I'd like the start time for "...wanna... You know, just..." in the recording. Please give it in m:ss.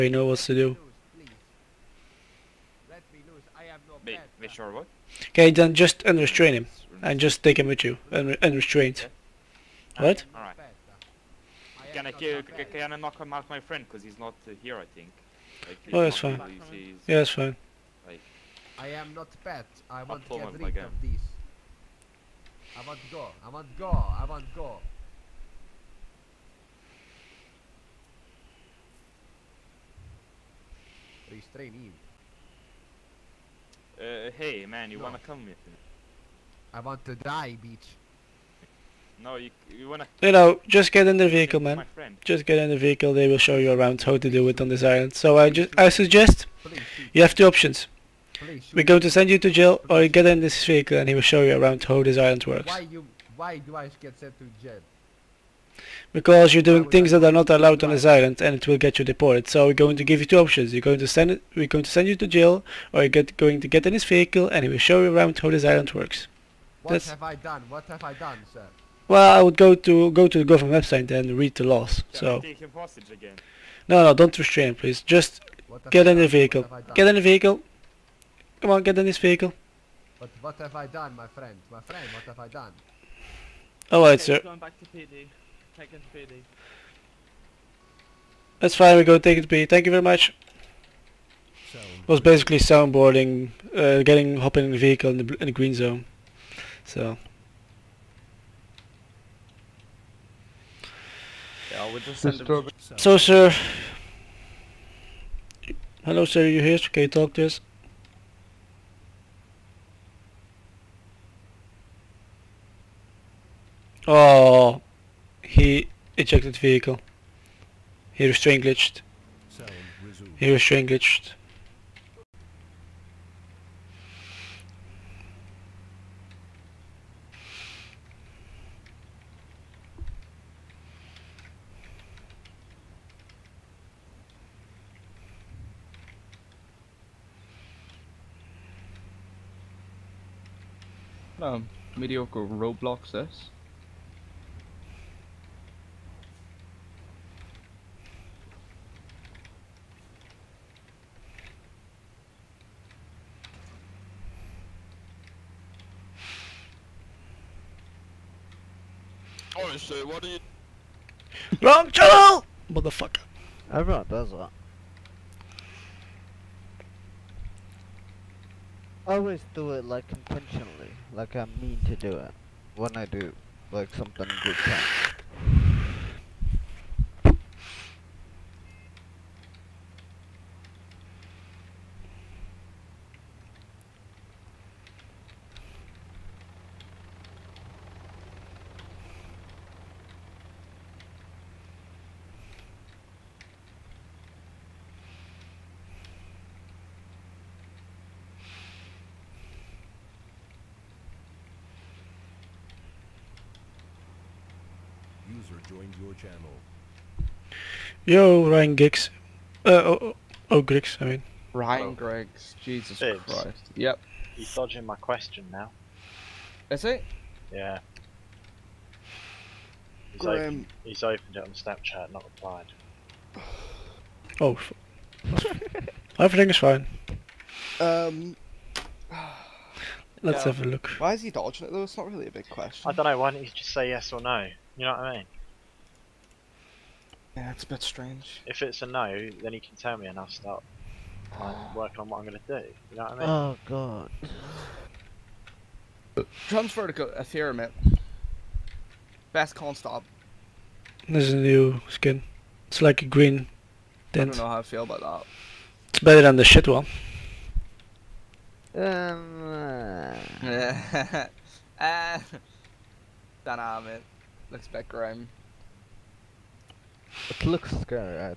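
0:39.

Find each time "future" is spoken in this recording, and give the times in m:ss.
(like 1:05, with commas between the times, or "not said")
not said.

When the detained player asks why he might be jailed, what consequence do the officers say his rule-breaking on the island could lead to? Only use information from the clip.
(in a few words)
deported.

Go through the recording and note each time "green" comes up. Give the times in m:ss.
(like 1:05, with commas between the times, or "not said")
1:35, 4:13.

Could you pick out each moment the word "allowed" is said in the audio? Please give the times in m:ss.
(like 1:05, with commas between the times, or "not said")
0:57.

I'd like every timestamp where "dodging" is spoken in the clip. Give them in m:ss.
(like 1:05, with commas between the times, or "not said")
3:34, 3:51.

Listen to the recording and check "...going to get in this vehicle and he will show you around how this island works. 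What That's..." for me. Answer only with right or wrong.
right.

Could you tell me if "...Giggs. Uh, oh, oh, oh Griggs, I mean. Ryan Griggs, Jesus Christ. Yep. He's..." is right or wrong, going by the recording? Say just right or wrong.
right.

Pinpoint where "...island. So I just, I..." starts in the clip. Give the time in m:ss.
0:44.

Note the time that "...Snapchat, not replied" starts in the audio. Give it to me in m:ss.
3:41.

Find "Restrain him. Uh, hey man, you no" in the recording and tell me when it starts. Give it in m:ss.
0:31.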